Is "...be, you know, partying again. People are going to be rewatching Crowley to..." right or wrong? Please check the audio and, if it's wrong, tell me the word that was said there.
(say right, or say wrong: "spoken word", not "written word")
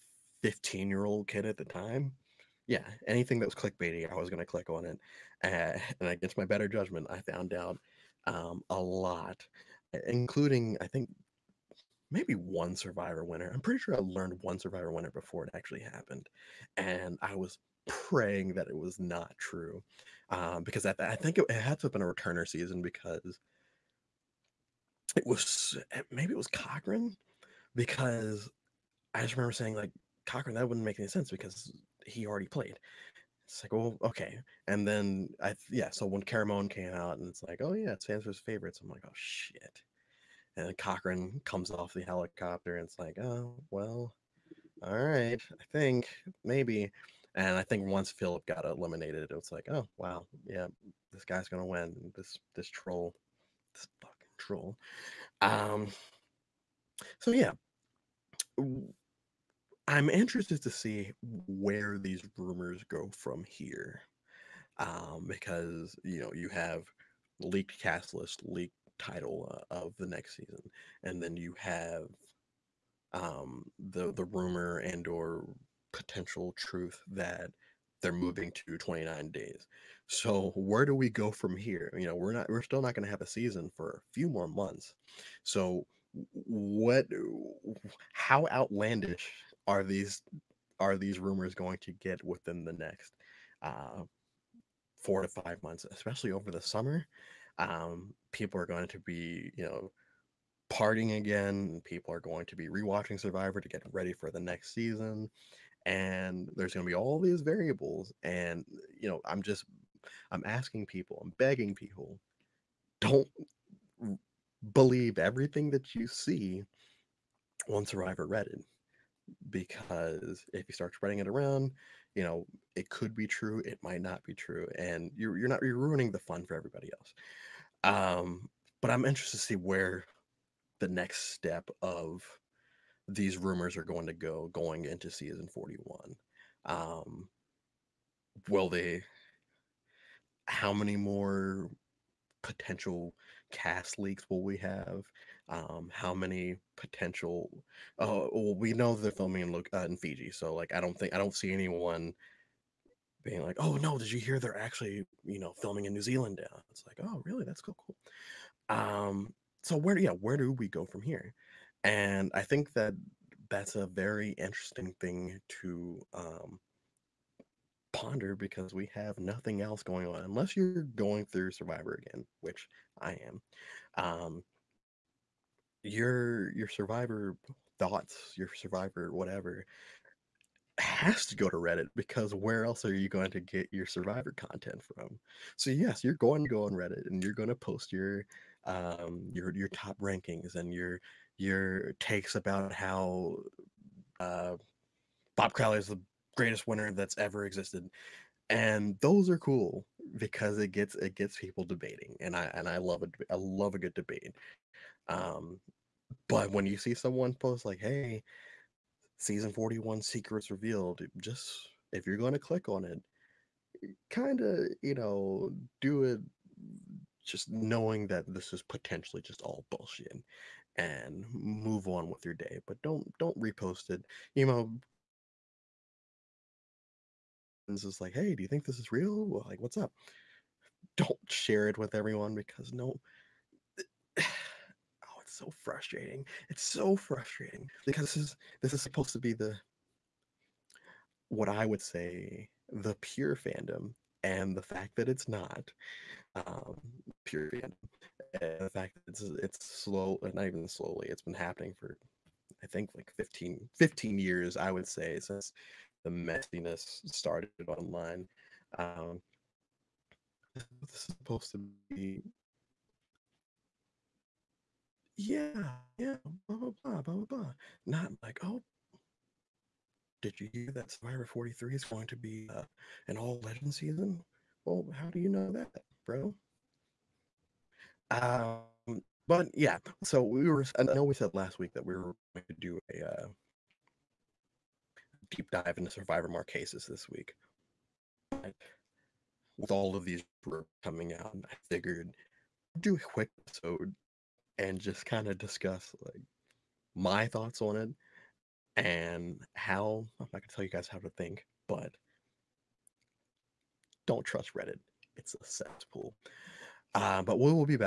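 wrong: "Survivor", not "Crowley".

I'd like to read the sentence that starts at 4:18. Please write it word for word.
Um, this is supposed to be yeah, yeah, blah blah blah blah blah.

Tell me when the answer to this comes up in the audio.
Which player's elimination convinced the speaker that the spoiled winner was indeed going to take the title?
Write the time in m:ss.
0:48.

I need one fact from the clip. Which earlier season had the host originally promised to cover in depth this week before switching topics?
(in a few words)
Marquesas.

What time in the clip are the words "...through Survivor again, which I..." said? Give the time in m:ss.
2:51.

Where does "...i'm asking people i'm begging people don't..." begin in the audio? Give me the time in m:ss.
1:50.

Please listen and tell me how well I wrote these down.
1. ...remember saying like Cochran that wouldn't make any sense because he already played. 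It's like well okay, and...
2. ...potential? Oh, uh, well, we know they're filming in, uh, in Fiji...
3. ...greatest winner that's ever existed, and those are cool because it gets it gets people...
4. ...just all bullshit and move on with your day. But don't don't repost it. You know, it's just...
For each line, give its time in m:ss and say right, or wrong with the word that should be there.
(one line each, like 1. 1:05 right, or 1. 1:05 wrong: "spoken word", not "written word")
1. 0:29 right
2. 2:26 right
3. 3:16 right
4. 3:39 right.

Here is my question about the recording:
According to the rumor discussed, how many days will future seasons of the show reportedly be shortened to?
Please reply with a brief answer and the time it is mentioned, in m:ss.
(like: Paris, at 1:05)
29, at 1:18.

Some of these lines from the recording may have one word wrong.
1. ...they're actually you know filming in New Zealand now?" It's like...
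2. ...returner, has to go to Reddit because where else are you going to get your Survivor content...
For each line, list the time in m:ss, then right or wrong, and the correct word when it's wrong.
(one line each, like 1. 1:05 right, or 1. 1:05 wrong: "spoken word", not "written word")
1. 2:34 right
2. 2:59 wrong: "whatever", not "returner".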